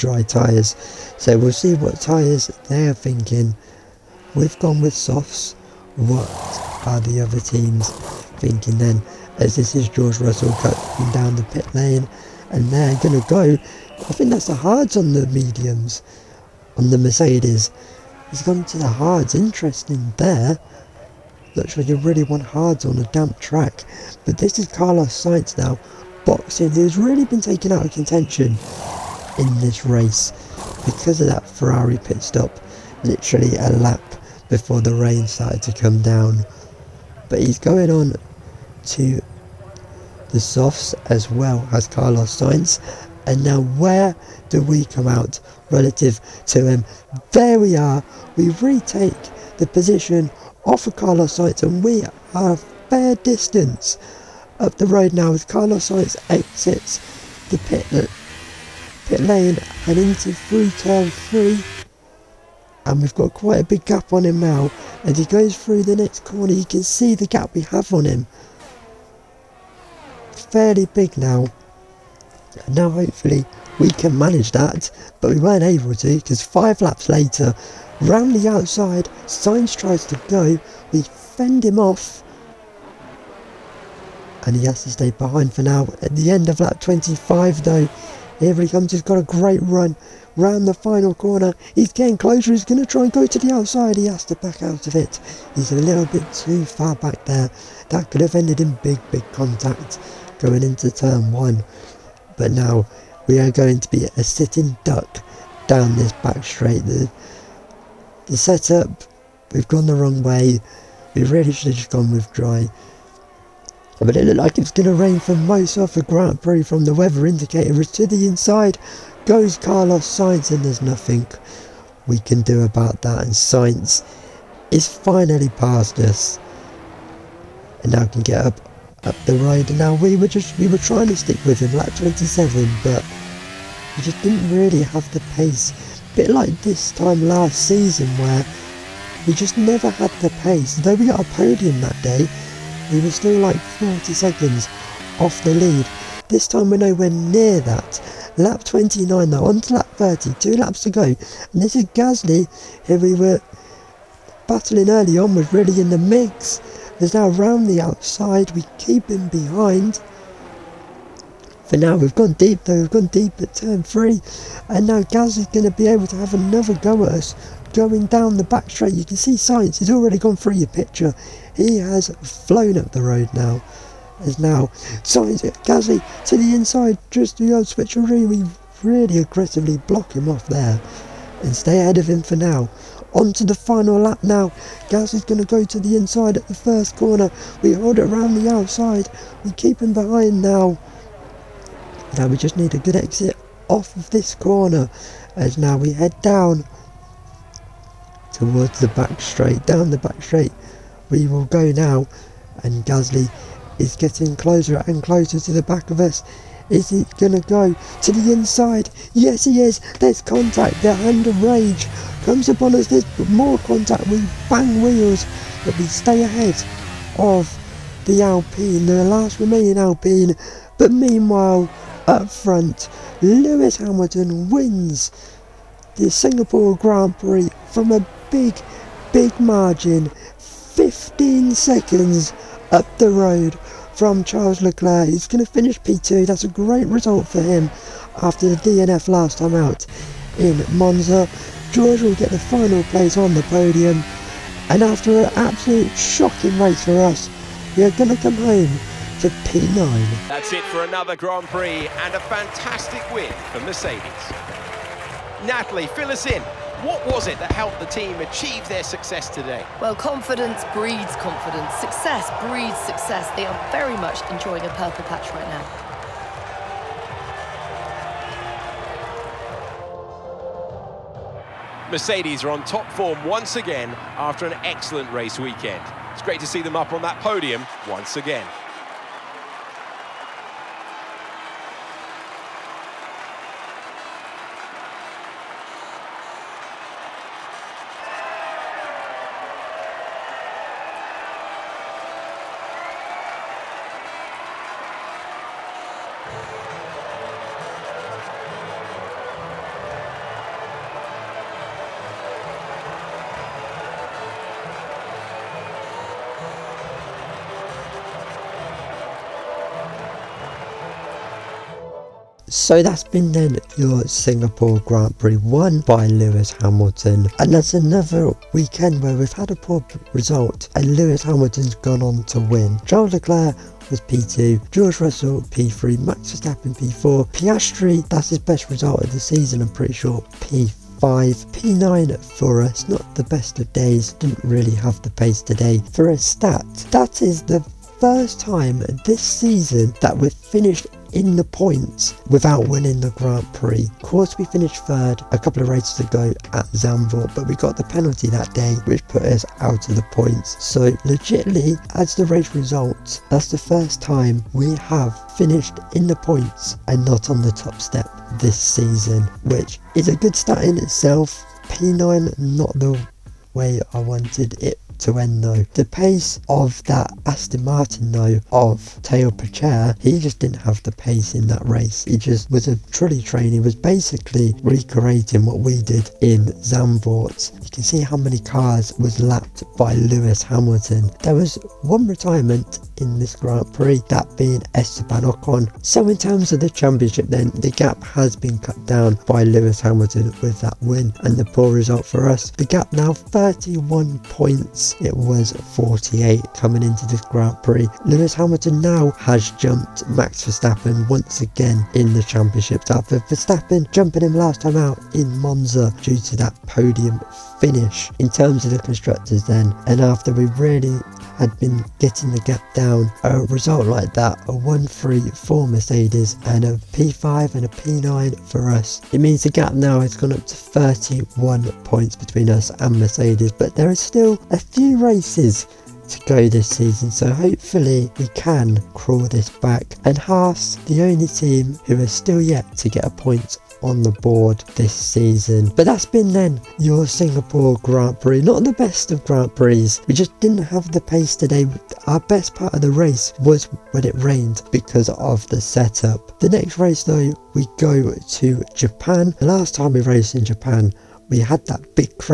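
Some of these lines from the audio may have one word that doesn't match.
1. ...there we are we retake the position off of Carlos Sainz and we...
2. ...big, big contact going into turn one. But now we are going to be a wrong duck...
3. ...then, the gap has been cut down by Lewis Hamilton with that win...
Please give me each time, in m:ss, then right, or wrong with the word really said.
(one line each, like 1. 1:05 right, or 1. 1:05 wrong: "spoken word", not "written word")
1. 0:47 right
2. 1:38 wrong: "sitting", not "wrong"
3. 6:27 right.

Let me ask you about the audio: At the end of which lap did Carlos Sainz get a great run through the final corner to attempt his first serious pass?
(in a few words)
25.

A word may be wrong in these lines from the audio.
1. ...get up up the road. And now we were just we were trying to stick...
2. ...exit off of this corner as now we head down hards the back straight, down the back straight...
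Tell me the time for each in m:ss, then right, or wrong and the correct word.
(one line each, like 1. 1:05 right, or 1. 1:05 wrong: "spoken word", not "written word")
1. 2:08 right
2. 3:12 wrong: "towards", not "hards".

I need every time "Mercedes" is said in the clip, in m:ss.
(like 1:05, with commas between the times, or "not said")
0:16, 4:13, 4:31, 6:55, 7:02.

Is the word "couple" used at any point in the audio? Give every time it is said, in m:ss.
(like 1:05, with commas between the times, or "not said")
5:45.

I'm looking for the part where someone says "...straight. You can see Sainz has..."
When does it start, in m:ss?
2:48.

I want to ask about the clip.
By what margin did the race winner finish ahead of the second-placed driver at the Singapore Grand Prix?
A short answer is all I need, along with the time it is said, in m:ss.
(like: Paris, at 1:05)
15 seconds, at 3:50.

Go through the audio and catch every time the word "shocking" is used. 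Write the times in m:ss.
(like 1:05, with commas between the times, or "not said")
4:05.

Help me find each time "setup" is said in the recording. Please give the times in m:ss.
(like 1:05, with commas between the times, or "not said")
1:48, 7:25.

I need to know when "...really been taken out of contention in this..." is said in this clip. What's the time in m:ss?
0:26.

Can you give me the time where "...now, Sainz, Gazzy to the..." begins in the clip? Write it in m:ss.
2:54.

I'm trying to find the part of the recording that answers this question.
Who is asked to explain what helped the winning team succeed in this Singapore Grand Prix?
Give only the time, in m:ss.
4:15.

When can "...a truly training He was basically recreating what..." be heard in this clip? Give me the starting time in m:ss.
6:12.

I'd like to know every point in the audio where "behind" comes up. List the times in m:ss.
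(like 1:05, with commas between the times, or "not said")
1:25, 2:39, 3:09.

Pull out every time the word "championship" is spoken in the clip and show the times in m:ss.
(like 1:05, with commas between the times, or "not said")
6:26, 6:42.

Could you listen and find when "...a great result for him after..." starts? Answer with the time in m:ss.
3:56.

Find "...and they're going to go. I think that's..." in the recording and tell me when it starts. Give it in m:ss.
0:12.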